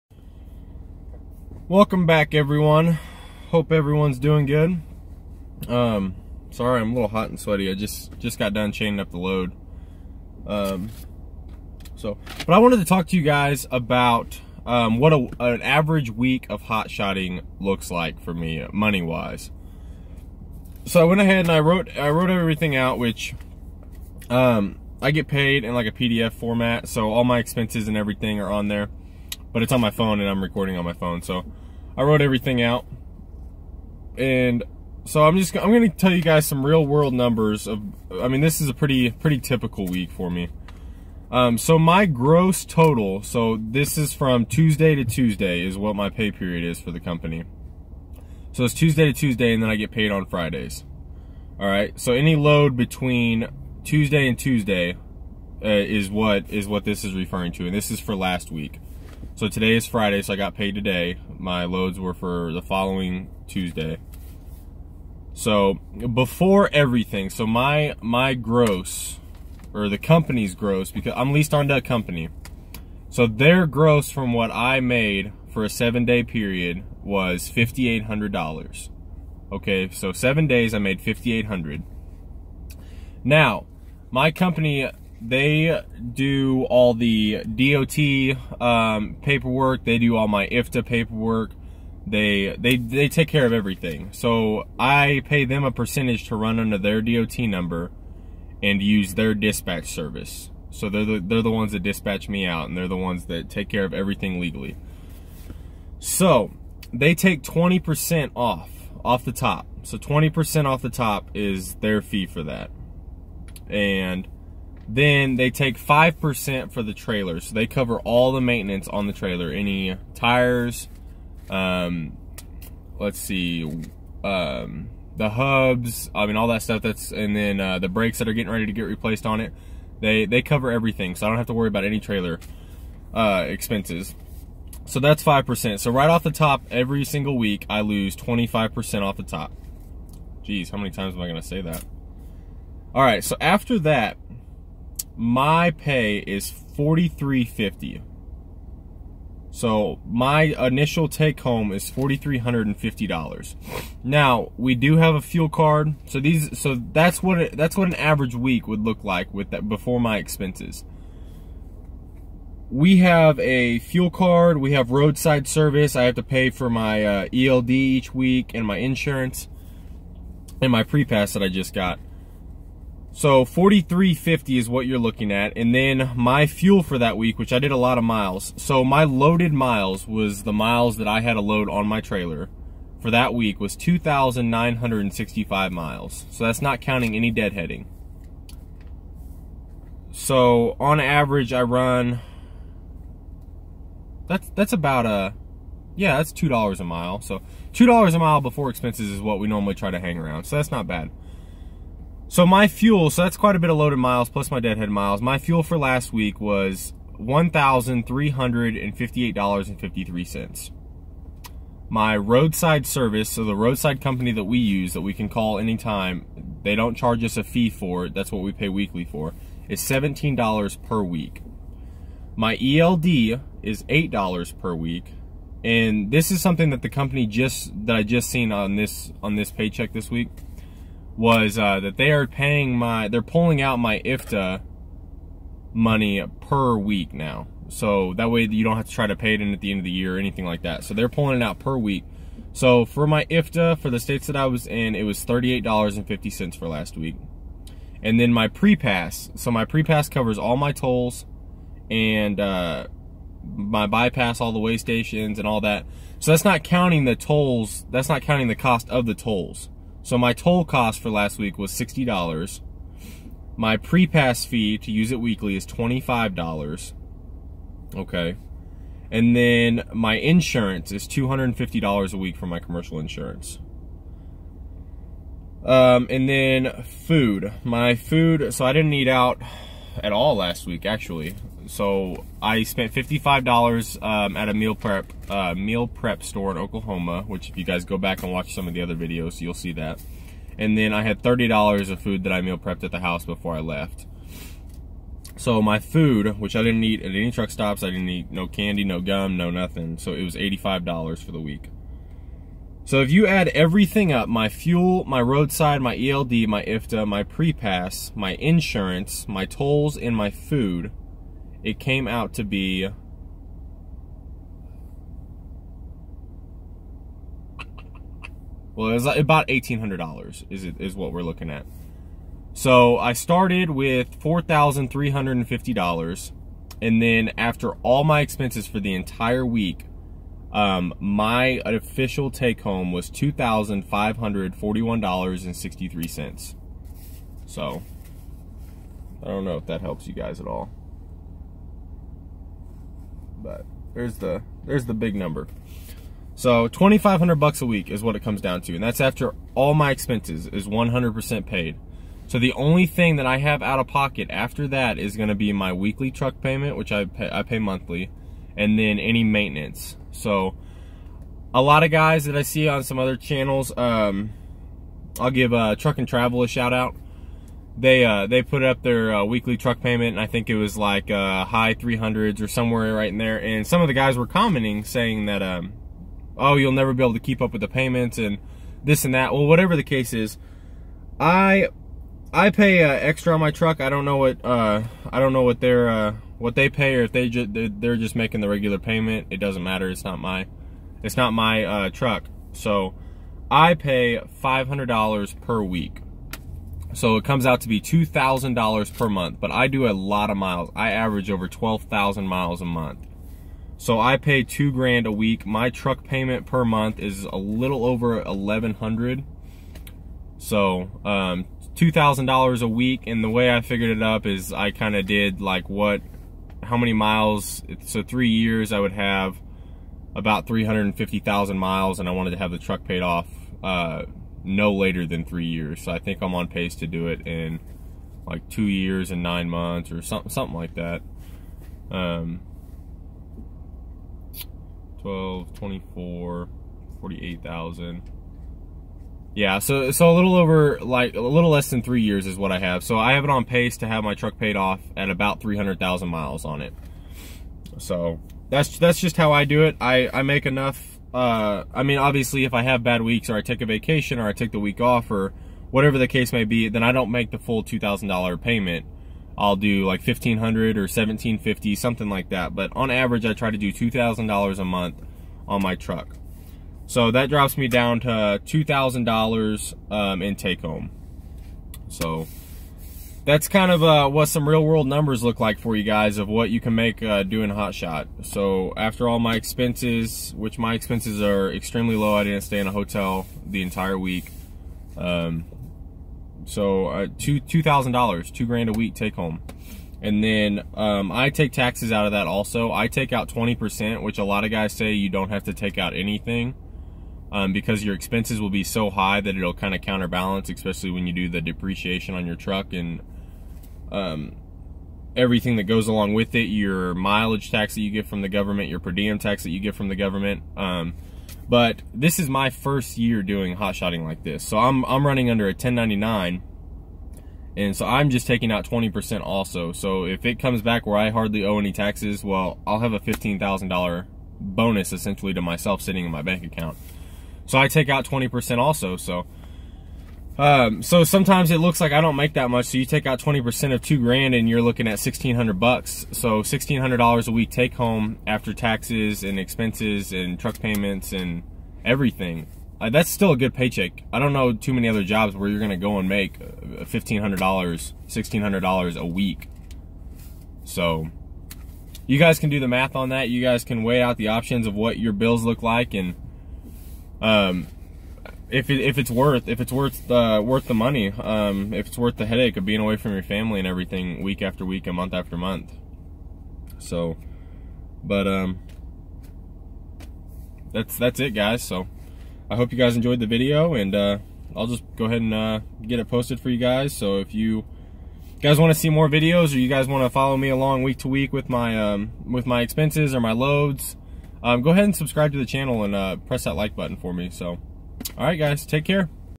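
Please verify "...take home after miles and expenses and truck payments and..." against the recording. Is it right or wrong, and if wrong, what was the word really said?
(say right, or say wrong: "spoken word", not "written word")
wrong: "taxes", not "miles".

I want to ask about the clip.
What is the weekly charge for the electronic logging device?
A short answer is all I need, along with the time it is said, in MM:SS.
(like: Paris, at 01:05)
$8, at 03:43.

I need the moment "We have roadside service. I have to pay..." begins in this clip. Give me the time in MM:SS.
02:44.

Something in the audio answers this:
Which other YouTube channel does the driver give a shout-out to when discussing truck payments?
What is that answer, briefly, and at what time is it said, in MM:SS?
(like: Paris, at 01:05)
Truck and Travel, at 06:05.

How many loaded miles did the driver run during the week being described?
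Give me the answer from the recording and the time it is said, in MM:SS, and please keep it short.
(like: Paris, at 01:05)
2,965, at 03:03.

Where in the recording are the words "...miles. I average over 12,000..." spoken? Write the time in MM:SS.
06:40.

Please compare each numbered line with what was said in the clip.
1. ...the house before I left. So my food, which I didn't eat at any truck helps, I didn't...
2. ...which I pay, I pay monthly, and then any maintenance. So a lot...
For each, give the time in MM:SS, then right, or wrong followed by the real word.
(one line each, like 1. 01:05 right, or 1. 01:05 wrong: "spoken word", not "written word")
1. 04:52 wrong: "stops", not "helps"
2. 05:56 right.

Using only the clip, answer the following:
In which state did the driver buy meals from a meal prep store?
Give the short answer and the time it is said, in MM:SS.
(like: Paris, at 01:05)
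Oklahoma, at 04:46.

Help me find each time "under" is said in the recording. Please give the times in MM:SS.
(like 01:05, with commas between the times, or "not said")
01:36, 08:35.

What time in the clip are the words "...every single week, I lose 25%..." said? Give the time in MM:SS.
02:16.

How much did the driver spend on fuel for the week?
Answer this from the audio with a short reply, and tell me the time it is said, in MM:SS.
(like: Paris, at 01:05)
$1,358.53, at 03:27.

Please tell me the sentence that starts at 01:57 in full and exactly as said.
So they cover all the maintenance on the trailer.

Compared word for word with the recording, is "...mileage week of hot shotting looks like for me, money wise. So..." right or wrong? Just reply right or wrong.
wrong.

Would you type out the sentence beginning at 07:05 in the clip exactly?
So I think I'm on pace to do it in like two years and nine months or something, something like that.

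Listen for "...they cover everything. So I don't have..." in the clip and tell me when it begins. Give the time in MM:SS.
02:10.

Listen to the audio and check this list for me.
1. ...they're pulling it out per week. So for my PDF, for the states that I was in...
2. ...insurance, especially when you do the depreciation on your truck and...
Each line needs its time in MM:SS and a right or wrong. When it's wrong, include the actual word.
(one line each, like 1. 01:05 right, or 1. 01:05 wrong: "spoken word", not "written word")
1. 04:00 wrong: "IFTA", not "PDF"
2. 08:19 wrong: "counterbalance", not "insurance".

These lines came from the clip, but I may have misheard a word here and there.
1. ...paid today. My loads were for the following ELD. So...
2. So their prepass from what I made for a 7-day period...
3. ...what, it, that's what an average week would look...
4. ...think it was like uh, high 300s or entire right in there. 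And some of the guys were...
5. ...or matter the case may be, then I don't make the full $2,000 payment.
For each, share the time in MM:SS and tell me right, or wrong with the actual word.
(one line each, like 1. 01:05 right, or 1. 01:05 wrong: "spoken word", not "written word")
1. 01:00 wrong: "Tuesday", not "ELD"
2. 01:13 wrong: "gross", not "prepass"
3. 02:37 right
4. 06:10 wrong: "somewhere", not "entire"
5. 07:35 wrong: "whatever", not "matter".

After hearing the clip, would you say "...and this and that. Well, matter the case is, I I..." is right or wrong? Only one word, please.
wrong.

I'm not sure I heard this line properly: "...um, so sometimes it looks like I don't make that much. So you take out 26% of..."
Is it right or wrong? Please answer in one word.
wrong.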